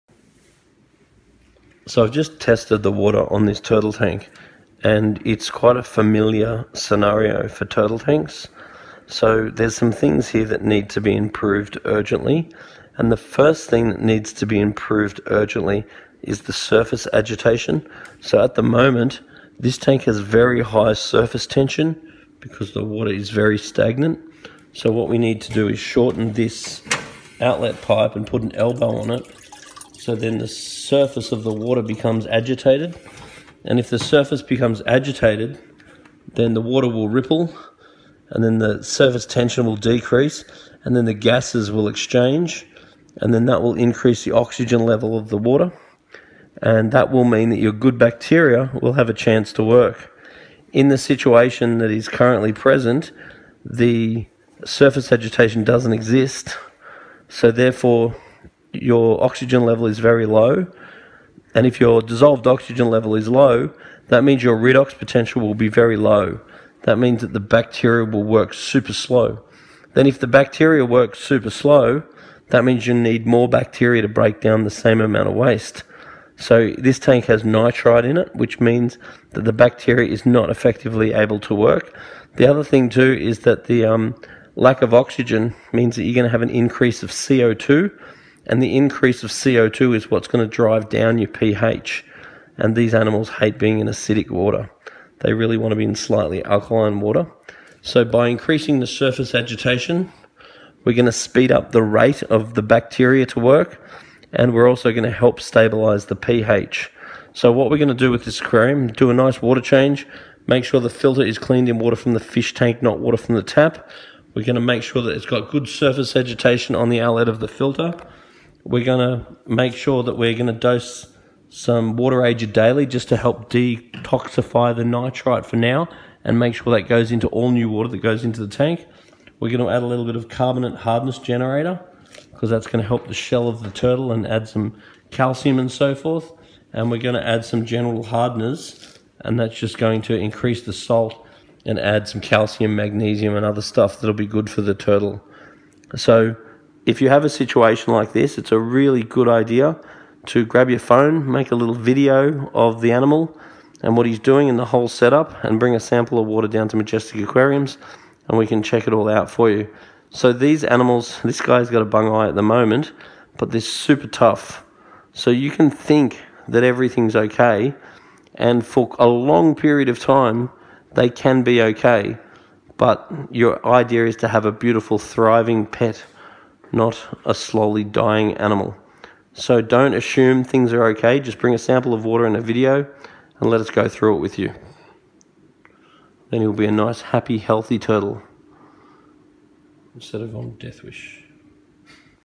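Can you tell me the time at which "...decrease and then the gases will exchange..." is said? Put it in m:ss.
0:39.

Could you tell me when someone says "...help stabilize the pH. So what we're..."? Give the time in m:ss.
1:45.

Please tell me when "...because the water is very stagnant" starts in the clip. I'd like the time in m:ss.
0:22.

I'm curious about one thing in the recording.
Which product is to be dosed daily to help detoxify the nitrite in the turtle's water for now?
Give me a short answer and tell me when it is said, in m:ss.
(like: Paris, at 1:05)
Water ager, at 2:01.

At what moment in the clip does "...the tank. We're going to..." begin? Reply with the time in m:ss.
2:08.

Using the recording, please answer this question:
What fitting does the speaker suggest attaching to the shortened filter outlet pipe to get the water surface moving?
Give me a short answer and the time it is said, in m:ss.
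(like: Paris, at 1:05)
An elbow, at 0:28.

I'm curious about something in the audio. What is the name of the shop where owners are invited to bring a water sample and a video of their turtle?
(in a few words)
Majestic Aquariums.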